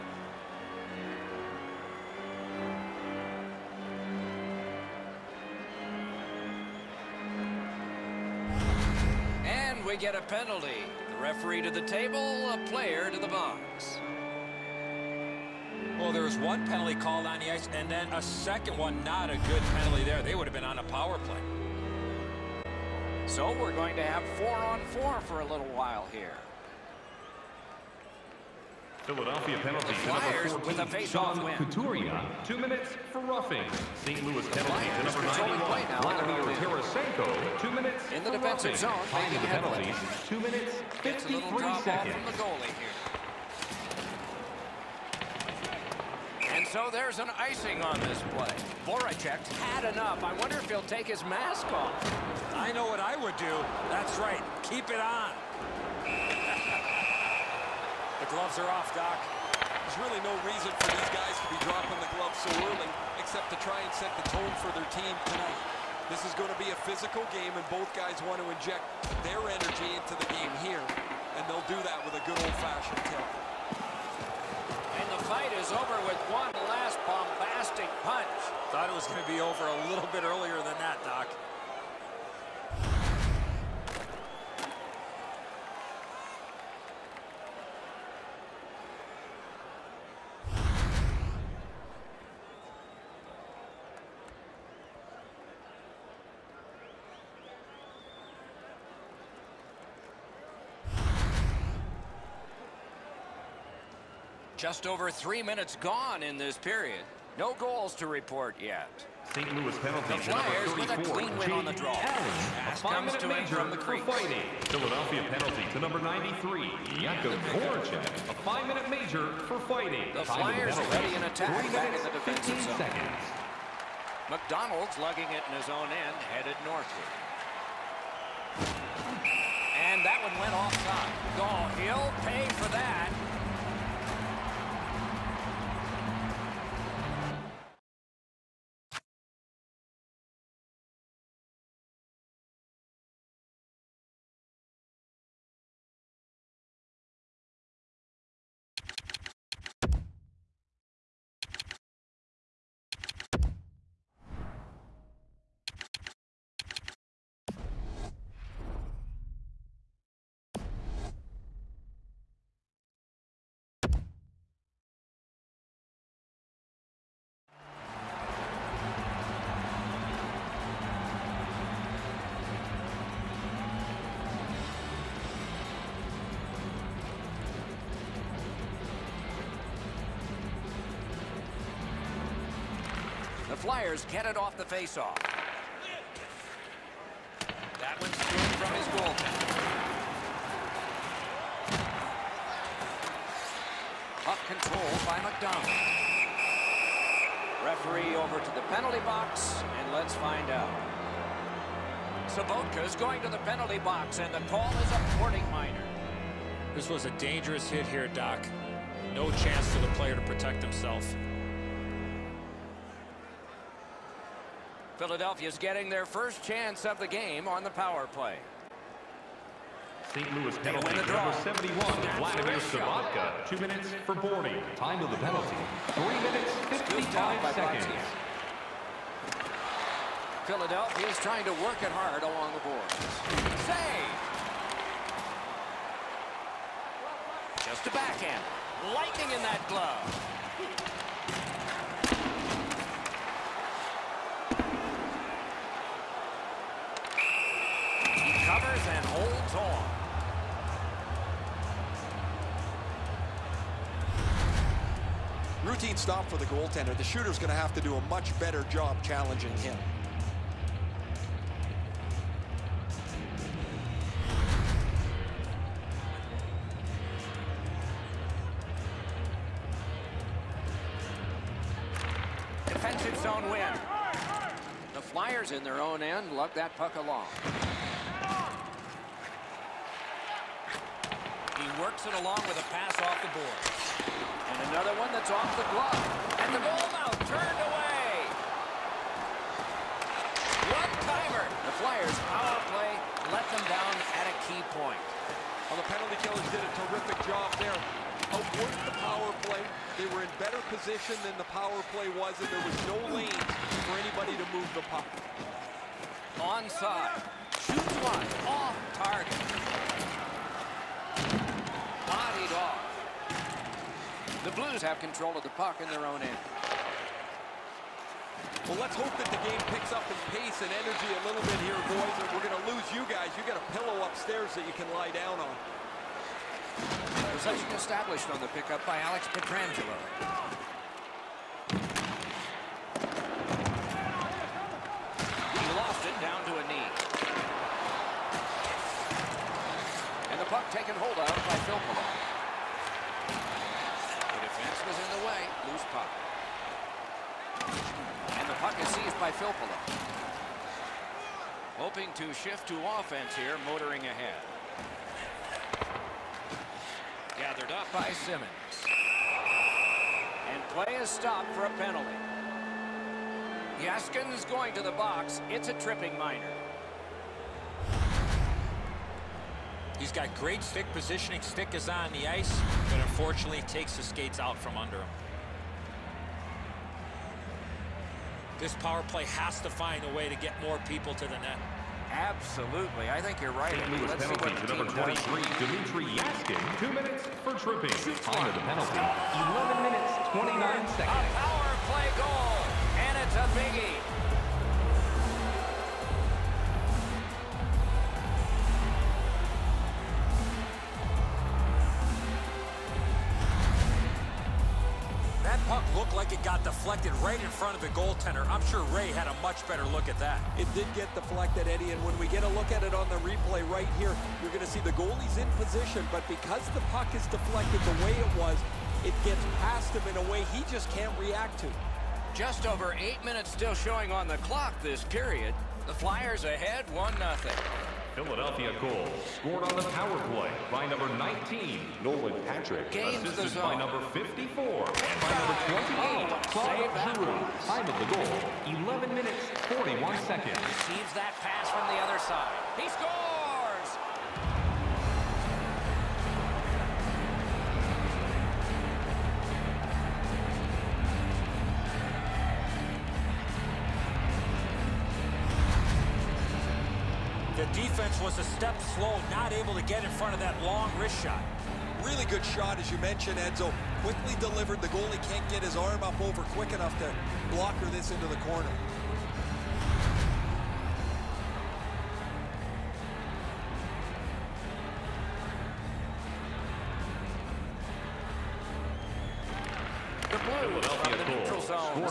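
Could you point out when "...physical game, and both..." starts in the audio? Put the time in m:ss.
1:06.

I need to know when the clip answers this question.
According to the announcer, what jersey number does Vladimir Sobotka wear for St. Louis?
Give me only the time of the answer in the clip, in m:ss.
3:41.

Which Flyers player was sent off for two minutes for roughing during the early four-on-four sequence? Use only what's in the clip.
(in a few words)
Couturier.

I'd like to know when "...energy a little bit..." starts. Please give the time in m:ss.
5:20.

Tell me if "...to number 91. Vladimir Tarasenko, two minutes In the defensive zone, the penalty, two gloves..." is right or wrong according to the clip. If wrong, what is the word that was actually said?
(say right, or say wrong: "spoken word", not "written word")
wrong: "minutes", not "gloves".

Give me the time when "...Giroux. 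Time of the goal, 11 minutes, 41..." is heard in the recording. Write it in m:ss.
7:17.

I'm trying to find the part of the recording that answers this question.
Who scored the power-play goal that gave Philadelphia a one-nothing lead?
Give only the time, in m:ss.
7:12.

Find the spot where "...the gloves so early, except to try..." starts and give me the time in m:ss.
1:01.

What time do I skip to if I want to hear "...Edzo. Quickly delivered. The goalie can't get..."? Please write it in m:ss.
7:43.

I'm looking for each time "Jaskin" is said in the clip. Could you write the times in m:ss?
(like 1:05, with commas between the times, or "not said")
6:03, 6:26.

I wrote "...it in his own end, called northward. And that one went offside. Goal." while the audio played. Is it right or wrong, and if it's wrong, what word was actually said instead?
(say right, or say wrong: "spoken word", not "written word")
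wrong: "headed", not "called".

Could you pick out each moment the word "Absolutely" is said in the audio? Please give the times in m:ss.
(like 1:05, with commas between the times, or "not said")
6:22.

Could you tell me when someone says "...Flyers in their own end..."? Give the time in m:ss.
4:35.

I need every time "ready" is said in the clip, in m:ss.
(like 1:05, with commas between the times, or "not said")
2:00.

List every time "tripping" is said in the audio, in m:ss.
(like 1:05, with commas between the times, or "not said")
6:05, 6:27.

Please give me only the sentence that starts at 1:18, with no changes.
Thought it was going to be over a little bit earlier than that, Doc.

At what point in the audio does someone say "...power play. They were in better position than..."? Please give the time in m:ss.
4:59.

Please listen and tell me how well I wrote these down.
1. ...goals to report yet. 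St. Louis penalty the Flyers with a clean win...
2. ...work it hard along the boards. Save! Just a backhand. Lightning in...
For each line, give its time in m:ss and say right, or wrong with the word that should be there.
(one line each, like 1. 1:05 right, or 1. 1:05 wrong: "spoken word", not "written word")
1. 1:47 right
2. 3:51 right.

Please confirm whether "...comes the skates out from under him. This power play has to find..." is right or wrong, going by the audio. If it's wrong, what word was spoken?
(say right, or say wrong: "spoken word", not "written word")
wrong: "takes", not "comes".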